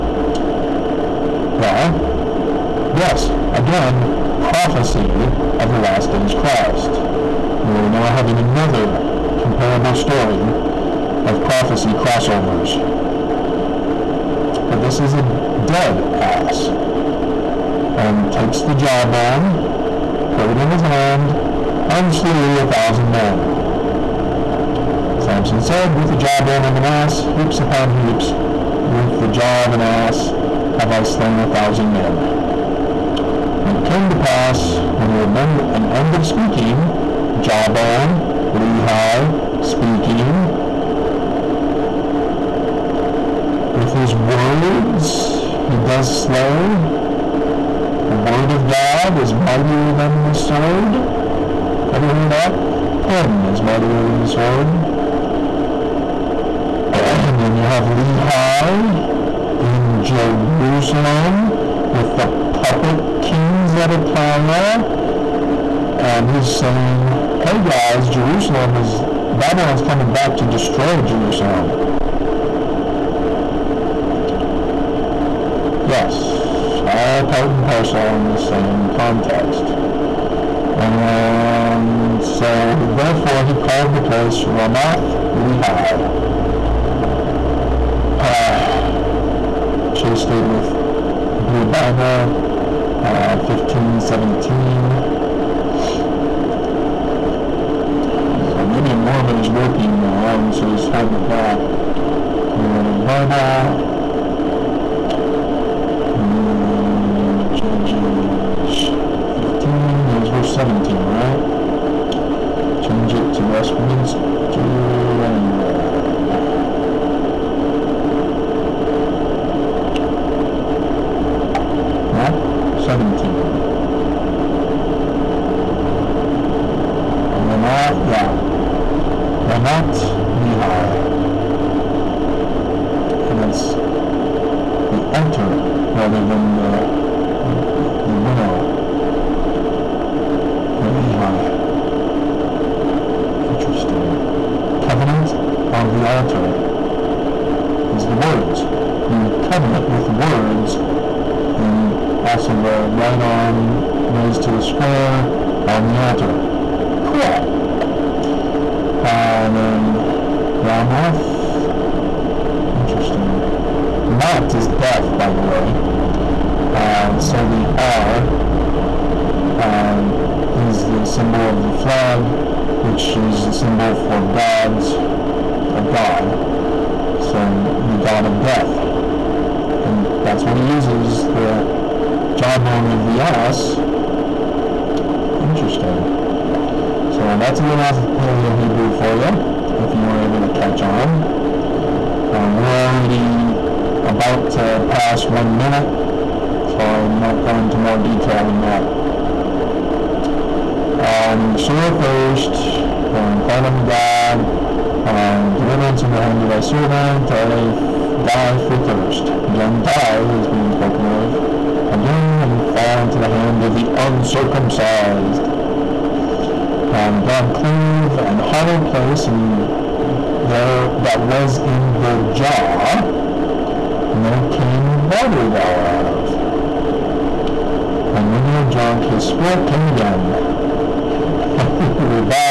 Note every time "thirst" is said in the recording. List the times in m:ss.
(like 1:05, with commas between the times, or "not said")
3:21, 3:28.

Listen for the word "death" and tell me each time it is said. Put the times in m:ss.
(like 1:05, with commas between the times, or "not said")
2:44, 2:58.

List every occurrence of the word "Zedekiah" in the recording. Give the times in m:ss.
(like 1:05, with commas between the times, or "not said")
1:03.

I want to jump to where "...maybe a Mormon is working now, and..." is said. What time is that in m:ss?
1:38.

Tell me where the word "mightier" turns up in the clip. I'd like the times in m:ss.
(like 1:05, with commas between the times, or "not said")
0:49, 0:53.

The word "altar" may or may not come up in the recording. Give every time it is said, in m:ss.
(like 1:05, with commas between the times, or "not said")
2:26, 2:35.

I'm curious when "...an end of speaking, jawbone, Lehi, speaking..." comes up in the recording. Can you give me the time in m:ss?
0:35.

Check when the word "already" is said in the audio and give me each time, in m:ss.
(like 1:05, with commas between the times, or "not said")
3:12.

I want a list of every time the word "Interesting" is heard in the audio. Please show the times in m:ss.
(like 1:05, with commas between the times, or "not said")
2:42, 3:05.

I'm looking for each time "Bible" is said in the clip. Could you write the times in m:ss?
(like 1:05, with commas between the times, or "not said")
1:31, 1:43.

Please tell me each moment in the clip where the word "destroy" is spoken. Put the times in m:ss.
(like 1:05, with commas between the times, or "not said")
1:10.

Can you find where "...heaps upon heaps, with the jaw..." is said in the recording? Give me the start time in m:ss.
0:27.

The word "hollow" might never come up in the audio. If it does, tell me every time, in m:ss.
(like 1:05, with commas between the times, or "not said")
3:38.